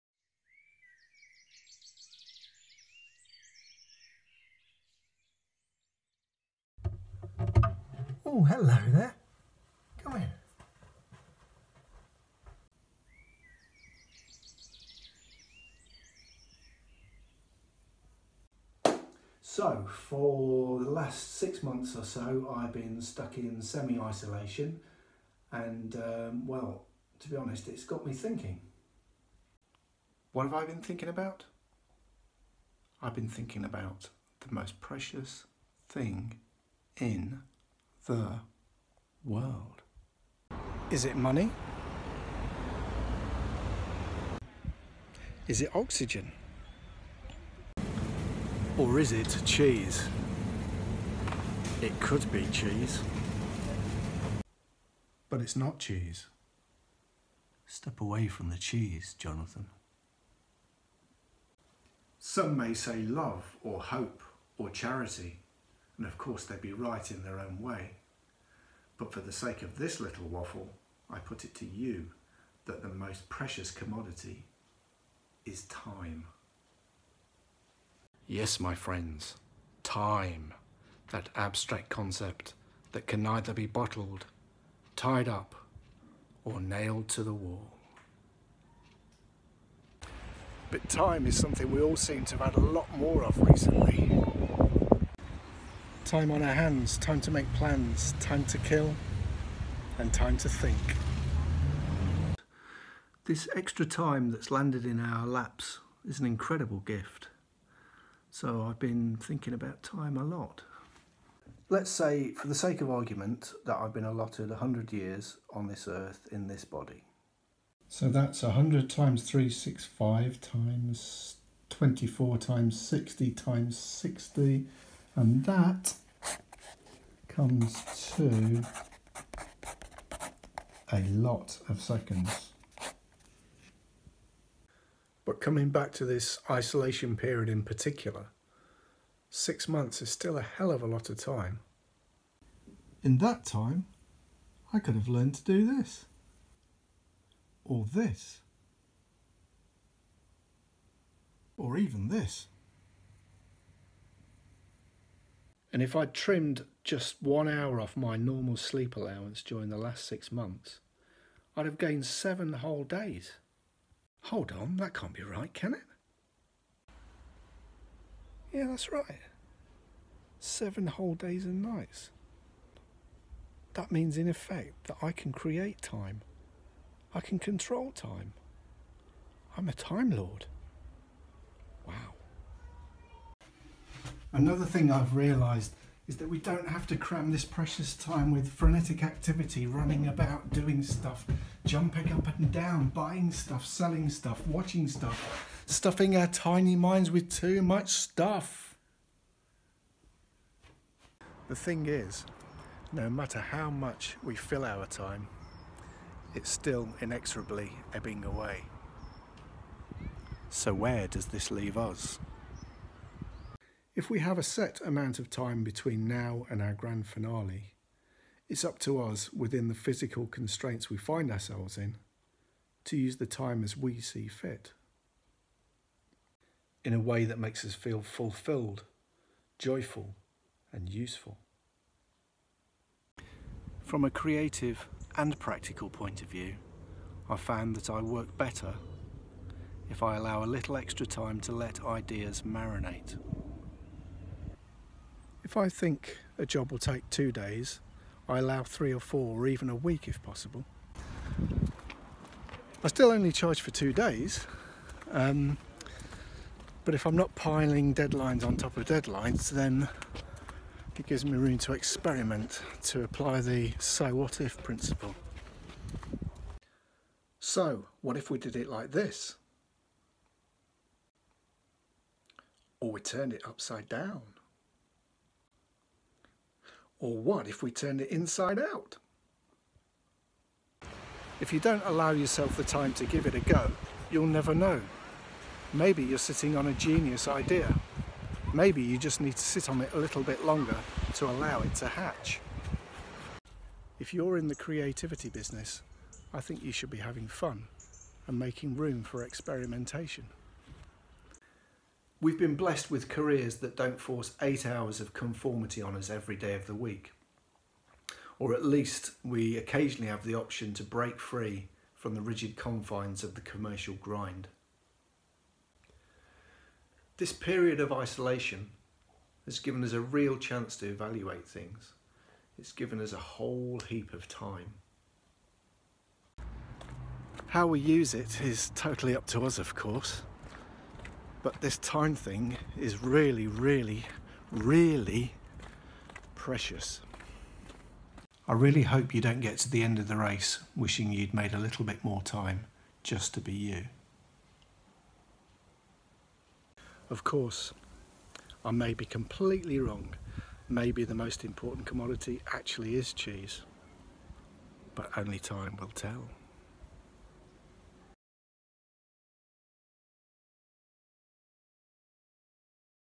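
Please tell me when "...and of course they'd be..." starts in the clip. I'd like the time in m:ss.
1:06.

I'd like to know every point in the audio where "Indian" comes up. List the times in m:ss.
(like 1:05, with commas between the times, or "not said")
not said.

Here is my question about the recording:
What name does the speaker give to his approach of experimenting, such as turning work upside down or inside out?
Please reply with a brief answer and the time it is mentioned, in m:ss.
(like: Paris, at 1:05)
so what if principle, at 4:23.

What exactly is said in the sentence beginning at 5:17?
This period of isolation has given us a real chance to evaluate things.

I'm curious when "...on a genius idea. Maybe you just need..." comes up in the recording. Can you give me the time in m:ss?
4:46.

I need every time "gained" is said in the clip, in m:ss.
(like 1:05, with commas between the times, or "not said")
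2:41.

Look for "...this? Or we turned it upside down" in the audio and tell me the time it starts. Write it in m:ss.
4:28.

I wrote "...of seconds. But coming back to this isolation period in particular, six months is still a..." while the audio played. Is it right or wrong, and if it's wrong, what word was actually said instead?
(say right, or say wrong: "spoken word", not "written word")
right.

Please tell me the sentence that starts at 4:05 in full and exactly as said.
If I think a job will take two days, I allow three or four or even a week if possible.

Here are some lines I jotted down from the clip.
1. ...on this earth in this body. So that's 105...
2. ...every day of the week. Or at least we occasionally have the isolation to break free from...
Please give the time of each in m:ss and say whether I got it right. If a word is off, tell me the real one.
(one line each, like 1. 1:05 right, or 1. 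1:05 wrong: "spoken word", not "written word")
1. 1:55 wrong: "100", not "105"
2. 5:06 wrong: "option", not "isolation".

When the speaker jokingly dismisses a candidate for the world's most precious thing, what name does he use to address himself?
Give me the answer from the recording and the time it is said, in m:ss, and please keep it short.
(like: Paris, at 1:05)
Jonathan, at 0:59.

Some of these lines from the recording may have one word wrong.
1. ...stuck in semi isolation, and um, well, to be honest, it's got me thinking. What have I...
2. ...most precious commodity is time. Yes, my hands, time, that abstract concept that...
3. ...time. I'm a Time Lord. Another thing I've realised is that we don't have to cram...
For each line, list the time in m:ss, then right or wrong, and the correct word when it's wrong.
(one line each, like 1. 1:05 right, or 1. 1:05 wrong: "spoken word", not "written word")
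1. 0:23 right
2. 1:12 wrong: "friends", not "hands"
3. 2:57 right.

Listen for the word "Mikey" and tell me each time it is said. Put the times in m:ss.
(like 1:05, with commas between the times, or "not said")
not said.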